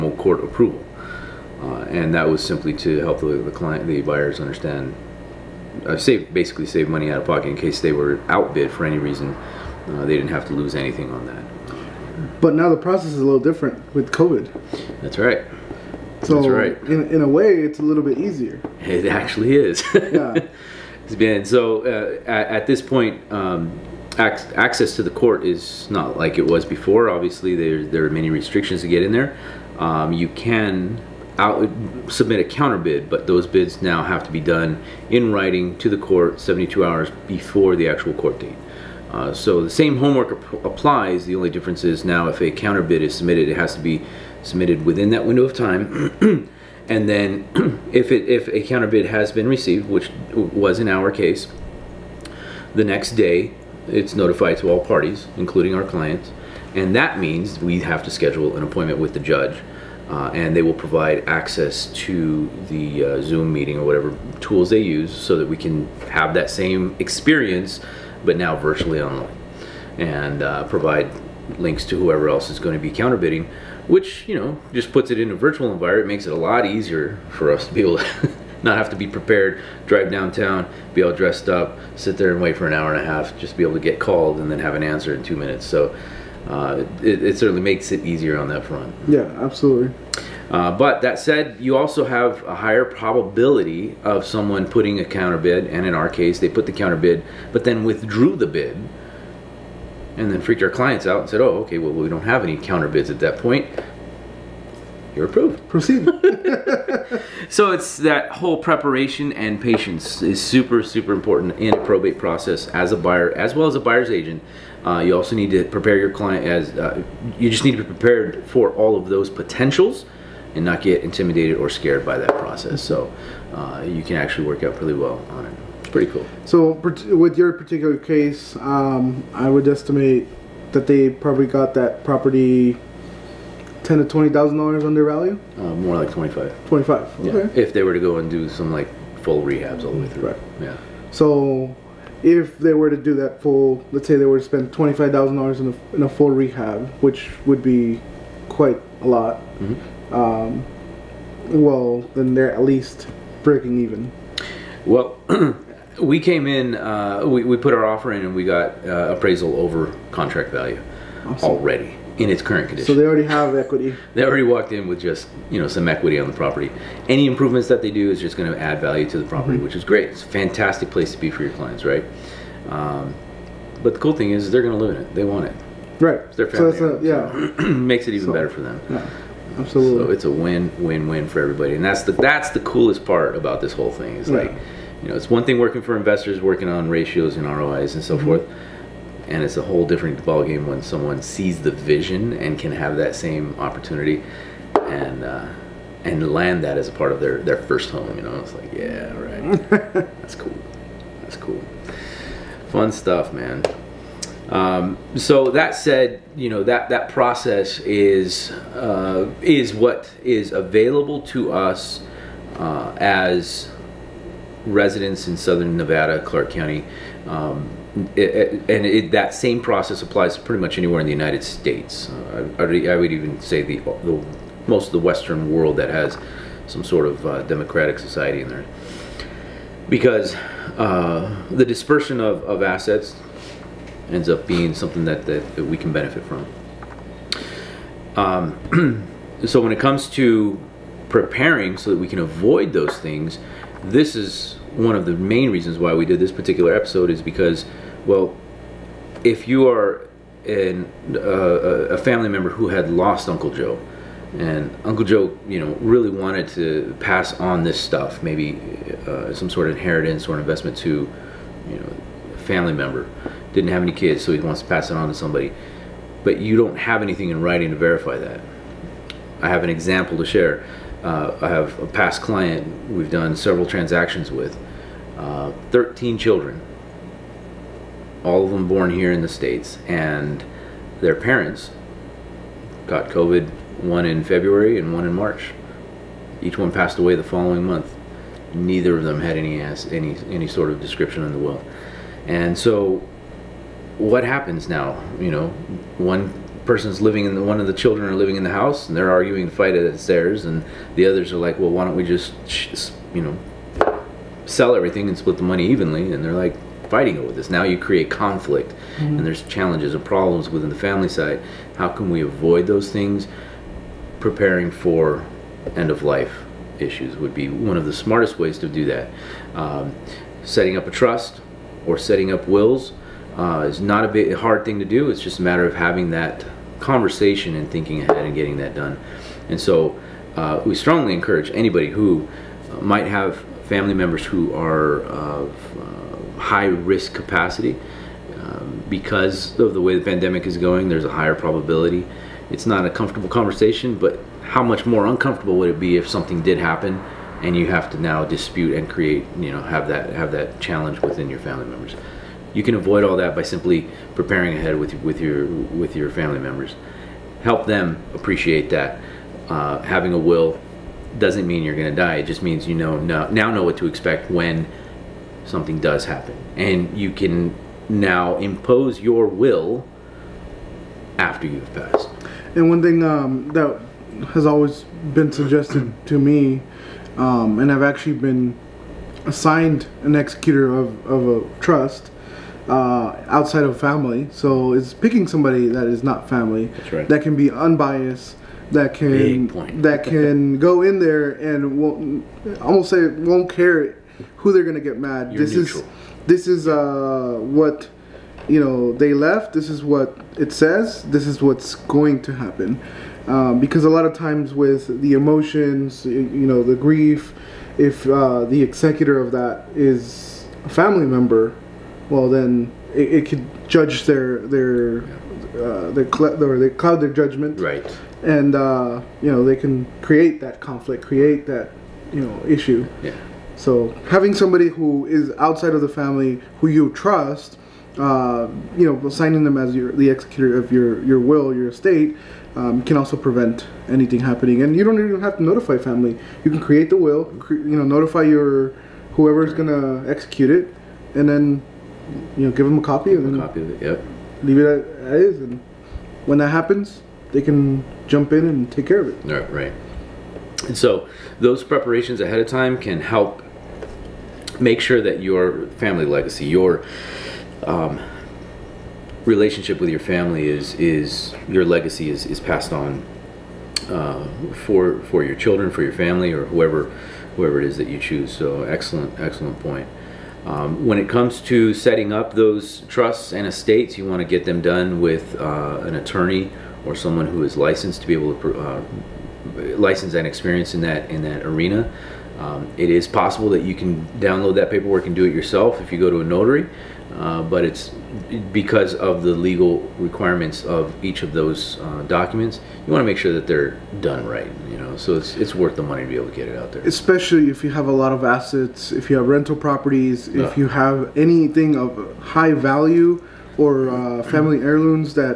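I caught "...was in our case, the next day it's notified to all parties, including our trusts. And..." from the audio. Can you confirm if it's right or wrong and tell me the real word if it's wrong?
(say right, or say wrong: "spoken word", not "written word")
wrong: "clients", not "trusts".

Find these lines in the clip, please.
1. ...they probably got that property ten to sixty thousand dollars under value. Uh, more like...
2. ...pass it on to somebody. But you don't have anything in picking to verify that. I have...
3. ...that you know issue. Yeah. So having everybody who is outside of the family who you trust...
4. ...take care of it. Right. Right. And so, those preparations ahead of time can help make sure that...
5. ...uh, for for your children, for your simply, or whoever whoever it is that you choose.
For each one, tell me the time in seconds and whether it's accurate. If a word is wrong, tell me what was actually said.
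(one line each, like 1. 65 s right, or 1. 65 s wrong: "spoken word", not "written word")
1. 130 s wrong: "twenty", not "sixty"
2. 264 s wrong: "writing", not "picking"
3. 421 s wrong: "somebody", not "everybody"
4. 448 s right
5. 463 s wrong: "family", not "simply".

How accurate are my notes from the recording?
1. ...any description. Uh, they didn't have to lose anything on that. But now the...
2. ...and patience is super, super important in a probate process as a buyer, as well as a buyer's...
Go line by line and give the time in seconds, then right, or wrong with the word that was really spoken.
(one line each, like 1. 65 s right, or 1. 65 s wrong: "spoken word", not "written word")
1. 8 s wrong: "reason", not "description"
2. 109 s right.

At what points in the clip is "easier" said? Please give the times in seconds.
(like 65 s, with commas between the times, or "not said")
18 s, 76 s, 88 s.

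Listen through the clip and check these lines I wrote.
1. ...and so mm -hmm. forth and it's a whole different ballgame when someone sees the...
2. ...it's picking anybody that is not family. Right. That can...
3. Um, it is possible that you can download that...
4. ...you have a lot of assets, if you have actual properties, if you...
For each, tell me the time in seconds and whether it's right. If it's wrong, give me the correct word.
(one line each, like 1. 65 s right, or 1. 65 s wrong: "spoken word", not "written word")
1. 187 s right
2. 384 s wrong: "somebody", not "anybody"
3. 482 s right
4. 497 s wrong: "rental", not "actual".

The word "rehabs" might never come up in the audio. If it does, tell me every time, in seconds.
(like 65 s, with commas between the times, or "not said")
139 s, 146 s.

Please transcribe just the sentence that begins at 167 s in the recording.
Any improvements that they do is just going to add value to the property, mm -hmm.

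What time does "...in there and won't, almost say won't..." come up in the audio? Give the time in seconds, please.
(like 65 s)
390 s.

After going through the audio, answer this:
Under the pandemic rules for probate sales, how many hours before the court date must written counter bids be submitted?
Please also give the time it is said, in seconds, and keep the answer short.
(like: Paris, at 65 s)
72, at 36 s.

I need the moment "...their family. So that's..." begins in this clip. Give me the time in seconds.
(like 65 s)
176 s.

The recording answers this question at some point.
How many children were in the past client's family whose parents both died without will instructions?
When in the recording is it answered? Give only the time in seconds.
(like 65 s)
275 s.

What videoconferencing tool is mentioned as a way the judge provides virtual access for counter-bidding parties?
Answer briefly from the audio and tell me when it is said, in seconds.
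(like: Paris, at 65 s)
Zoom, at 63 s.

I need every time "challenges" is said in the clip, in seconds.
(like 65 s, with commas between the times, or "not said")
309 s, 350 s.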